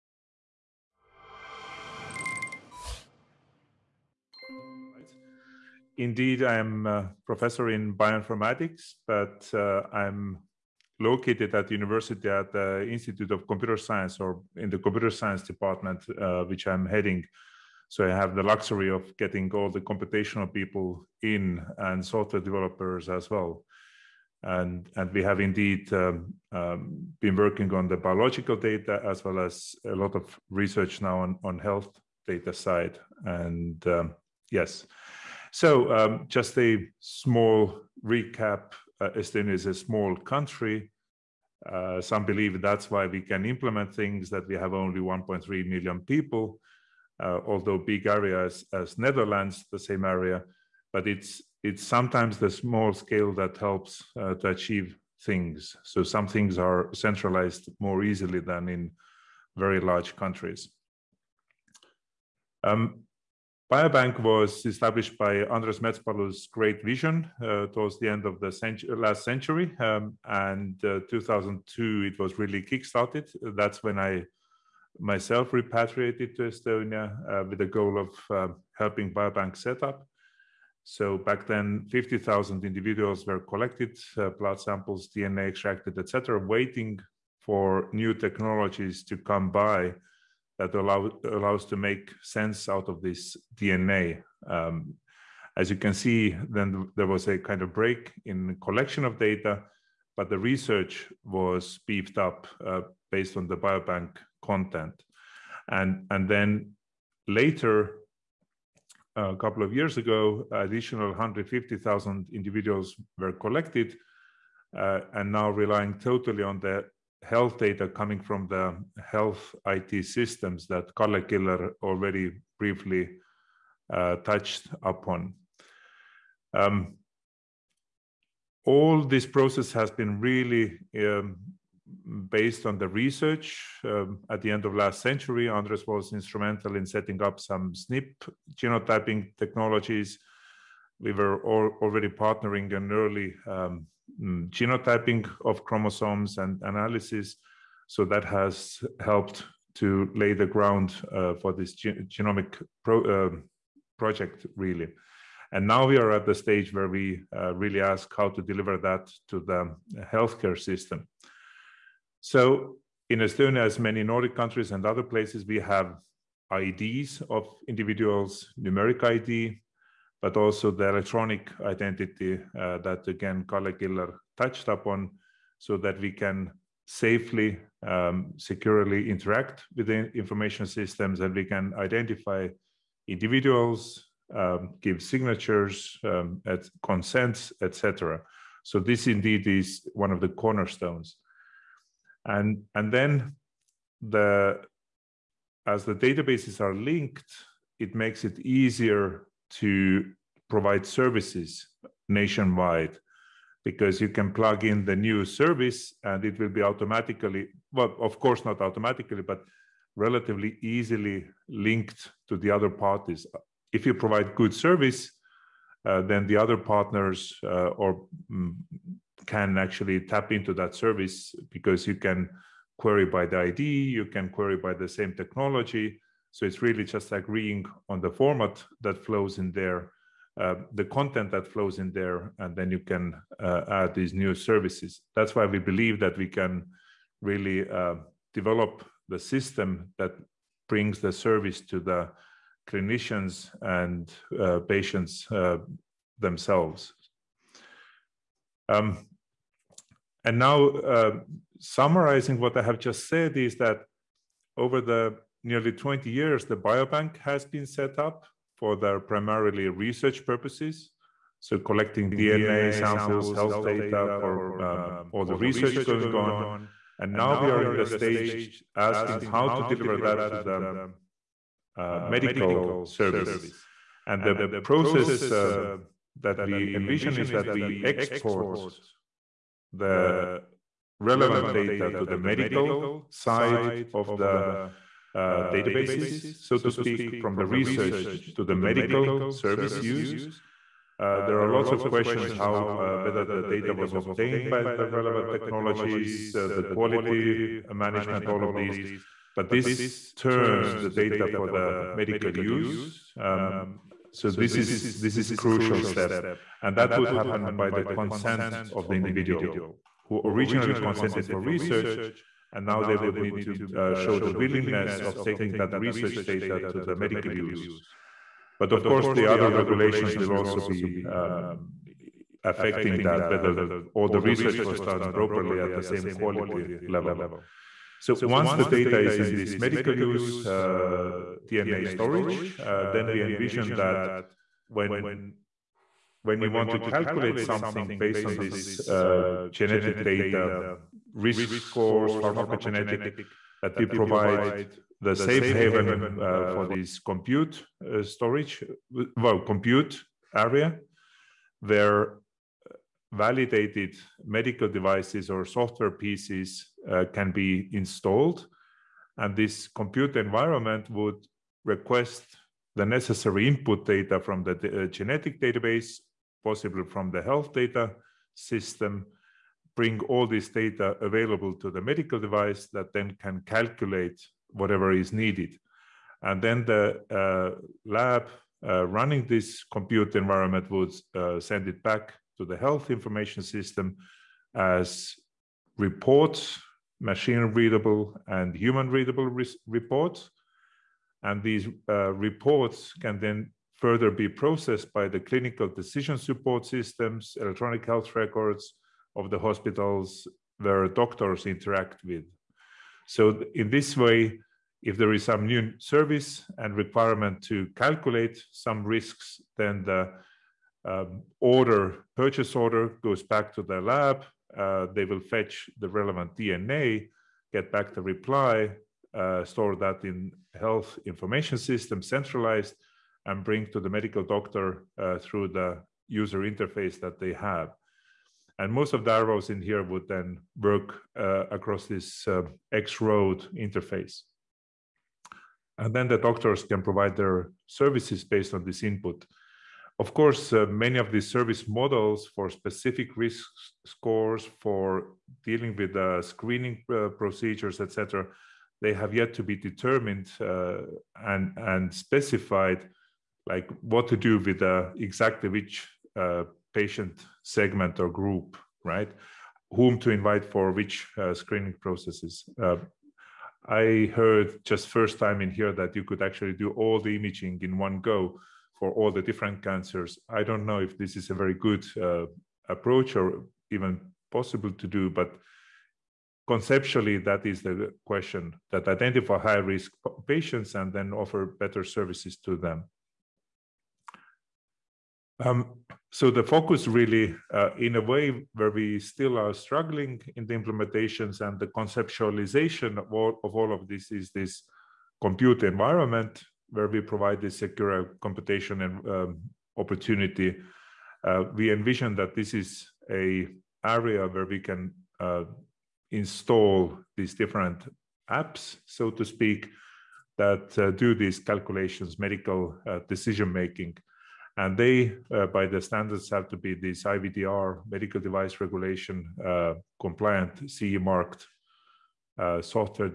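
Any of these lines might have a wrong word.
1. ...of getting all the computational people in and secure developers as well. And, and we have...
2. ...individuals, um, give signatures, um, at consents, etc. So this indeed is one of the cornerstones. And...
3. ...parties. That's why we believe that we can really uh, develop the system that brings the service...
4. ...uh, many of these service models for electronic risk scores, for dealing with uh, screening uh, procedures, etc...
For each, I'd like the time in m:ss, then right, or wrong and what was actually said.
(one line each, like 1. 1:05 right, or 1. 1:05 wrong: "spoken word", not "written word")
1. 0:18 wrong: "software", not "secure"
2. 3:03 right
3. 3:54 wrong: "services", not "parties"
4. 7:20 wrong: "specific", not "electronic".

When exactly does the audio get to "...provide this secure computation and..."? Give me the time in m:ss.
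8:17.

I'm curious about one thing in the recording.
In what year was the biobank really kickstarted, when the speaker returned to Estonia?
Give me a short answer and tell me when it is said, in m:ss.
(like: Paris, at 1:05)
2002, at 1:11.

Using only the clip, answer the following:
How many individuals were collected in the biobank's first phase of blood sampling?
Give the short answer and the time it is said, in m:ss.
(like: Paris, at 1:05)
50,000, at 1:21.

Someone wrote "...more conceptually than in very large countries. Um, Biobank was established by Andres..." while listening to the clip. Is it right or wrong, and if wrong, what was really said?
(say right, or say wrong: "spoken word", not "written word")
wrong: "easily", not "conceptually".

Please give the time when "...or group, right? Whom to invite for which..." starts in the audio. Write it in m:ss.
7:38.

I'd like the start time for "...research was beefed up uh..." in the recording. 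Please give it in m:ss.
1:40.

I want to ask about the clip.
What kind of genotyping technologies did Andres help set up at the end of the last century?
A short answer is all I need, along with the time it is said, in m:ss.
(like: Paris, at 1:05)
SNP genotyping, at 2:17.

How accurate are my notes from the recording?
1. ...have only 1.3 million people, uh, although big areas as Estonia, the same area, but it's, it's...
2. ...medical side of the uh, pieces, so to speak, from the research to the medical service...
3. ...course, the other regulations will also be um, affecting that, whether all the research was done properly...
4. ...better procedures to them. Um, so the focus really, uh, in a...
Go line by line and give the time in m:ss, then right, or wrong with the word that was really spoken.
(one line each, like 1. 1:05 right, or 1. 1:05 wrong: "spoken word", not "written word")
1. 0:44 wrong: "Netherlands", not "Estonia"
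2. 4:42 wrong: "databases", not "pieces"
3. 5:18 right
4. 8:01 wrong: "services", not "procedures".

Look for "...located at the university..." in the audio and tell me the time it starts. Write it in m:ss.
0:11.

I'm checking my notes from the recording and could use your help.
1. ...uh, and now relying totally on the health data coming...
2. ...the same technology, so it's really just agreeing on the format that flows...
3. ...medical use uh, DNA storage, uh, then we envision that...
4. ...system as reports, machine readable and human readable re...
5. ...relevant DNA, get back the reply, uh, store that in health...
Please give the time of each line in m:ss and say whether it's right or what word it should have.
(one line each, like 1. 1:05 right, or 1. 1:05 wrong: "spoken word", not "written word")
1. 1:54 right
2. 3:44 right
3. 5:29 right
4. 6:23 right
5. 6:55 right.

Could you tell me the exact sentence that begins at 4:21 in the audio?
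So collecting DNA samples, health data for um, all the research going on.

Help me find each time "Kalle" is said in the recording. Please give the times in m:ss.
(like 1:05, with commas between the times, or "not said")
2:00, 2:53.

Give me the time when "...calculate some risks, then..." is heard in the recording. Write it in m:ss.
6:47.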